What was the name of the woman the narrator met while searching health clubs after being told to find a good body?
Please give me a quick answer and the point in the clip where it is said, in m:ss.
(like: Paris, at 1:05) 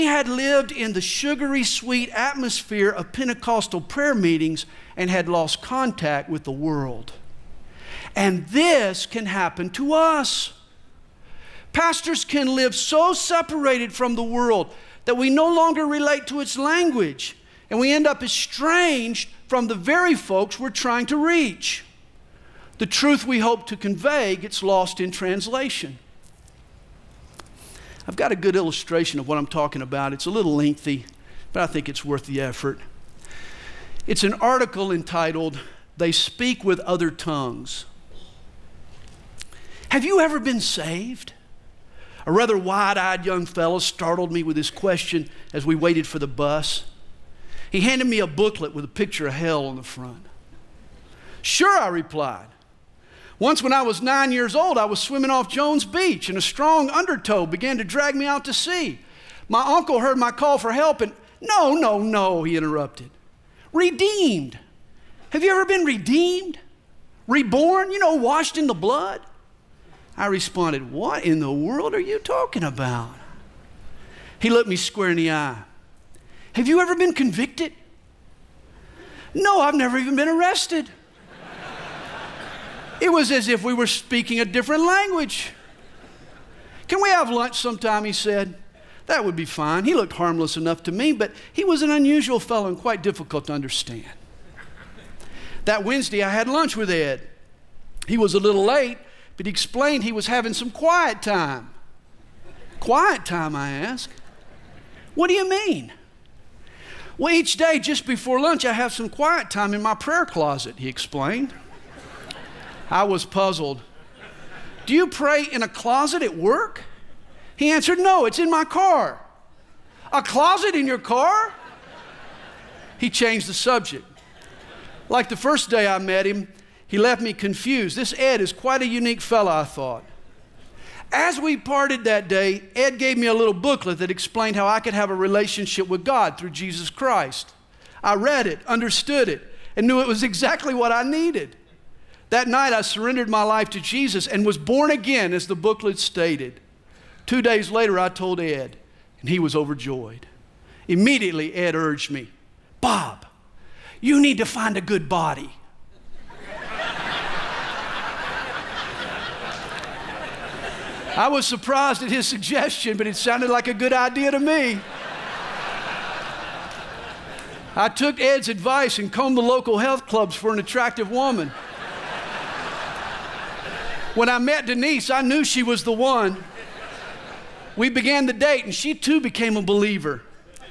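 Denise, at 2:54.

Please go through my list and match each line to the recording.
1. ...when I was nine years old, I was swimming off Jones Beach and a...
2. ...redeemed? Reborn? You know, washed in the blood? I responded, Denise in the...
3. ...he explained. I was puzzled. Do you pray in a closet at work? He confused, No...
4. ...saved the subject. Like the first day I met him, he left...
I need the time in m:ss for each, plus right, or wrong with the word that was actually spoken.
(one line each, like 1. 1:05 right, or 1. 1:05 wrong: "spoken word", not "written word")
1. 0:53 right
2. 1:05 wrong: "What", not "Denise"
3. 1:50 wrong: "answered", not "confused"
4. 2:03 wrong: "changed", not "saved".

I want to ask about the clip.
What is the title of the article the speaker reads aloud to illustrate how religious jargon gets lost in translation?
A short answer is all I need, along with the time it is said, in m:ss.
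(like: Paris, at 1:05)
They Speak with Other Tongues, at 0:35.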